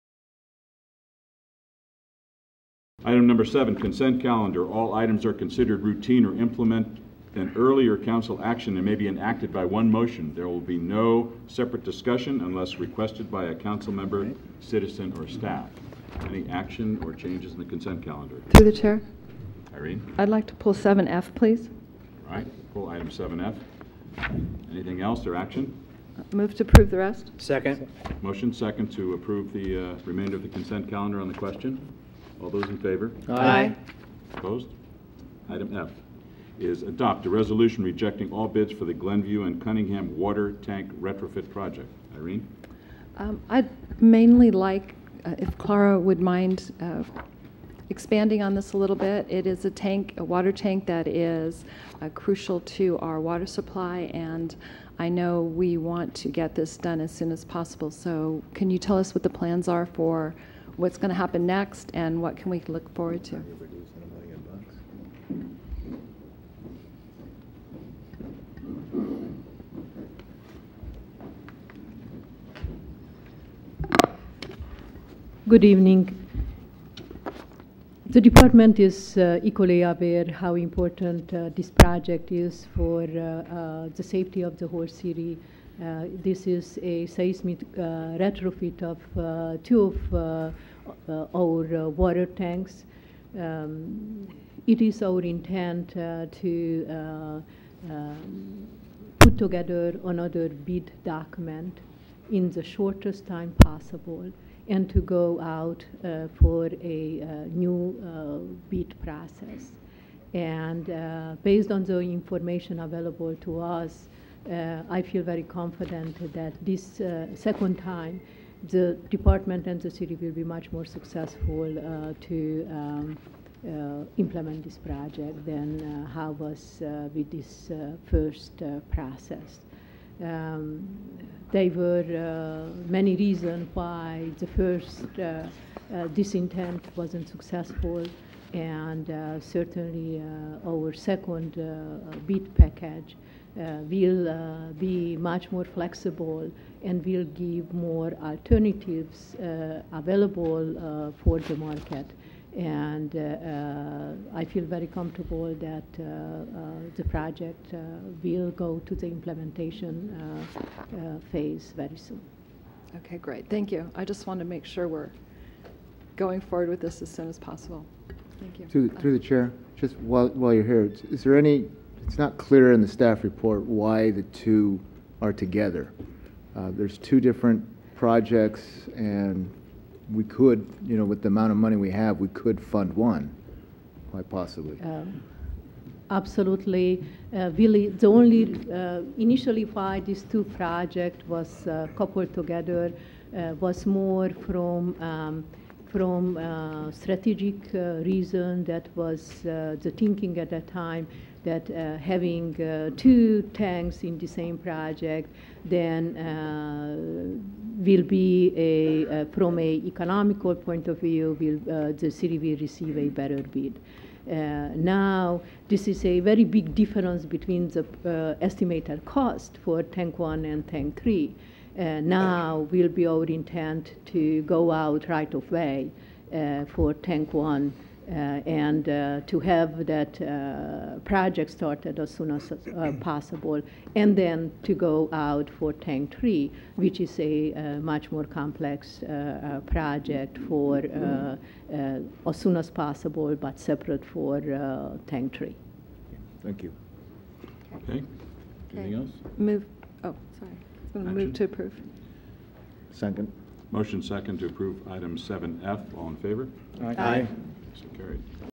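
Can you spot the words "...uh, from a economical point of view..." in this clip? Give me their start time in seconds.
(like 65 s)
209 s.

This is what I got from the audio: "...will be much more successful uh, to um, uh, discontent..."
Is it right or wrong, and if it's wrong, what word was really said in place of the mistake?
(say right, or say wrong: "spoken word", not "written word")
wrong: "implement", not "discontent".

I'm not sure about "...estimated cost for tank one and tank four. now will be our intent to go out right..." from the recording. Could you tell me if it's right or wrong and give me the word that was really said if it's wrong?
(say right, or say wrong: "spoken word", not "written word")
wrong: "three", not "four".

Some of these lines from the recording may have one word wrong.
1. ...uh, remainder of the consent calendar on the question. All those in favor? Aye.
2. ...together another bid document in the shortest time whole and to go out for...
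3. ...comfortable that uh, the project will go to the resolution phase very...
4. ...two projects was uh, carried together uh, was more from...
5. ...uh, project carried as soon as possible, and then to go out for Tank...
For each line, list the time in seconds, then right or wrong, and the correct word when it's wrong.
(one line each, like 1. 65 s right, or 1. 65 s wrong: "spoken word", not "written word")
1. 29 s right
2. 99 s wrong: "possible", not "whole"
3. 154 s wrong: "implementation", not "resolution"
4. 190 s wrong: "coupled", not "carried"
5. 230 s wrong: "started", not "carried".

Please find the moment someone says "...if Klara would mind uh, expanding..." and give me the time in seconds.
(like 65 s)
45 s.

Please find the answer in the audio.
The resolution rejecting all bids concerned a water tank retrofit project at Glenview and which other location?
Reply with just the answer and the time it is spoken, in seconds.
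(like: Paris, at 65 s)
Cunningham, at 39 s.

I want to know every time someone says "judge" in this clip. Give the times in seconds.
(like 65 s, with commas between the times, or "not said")
not said.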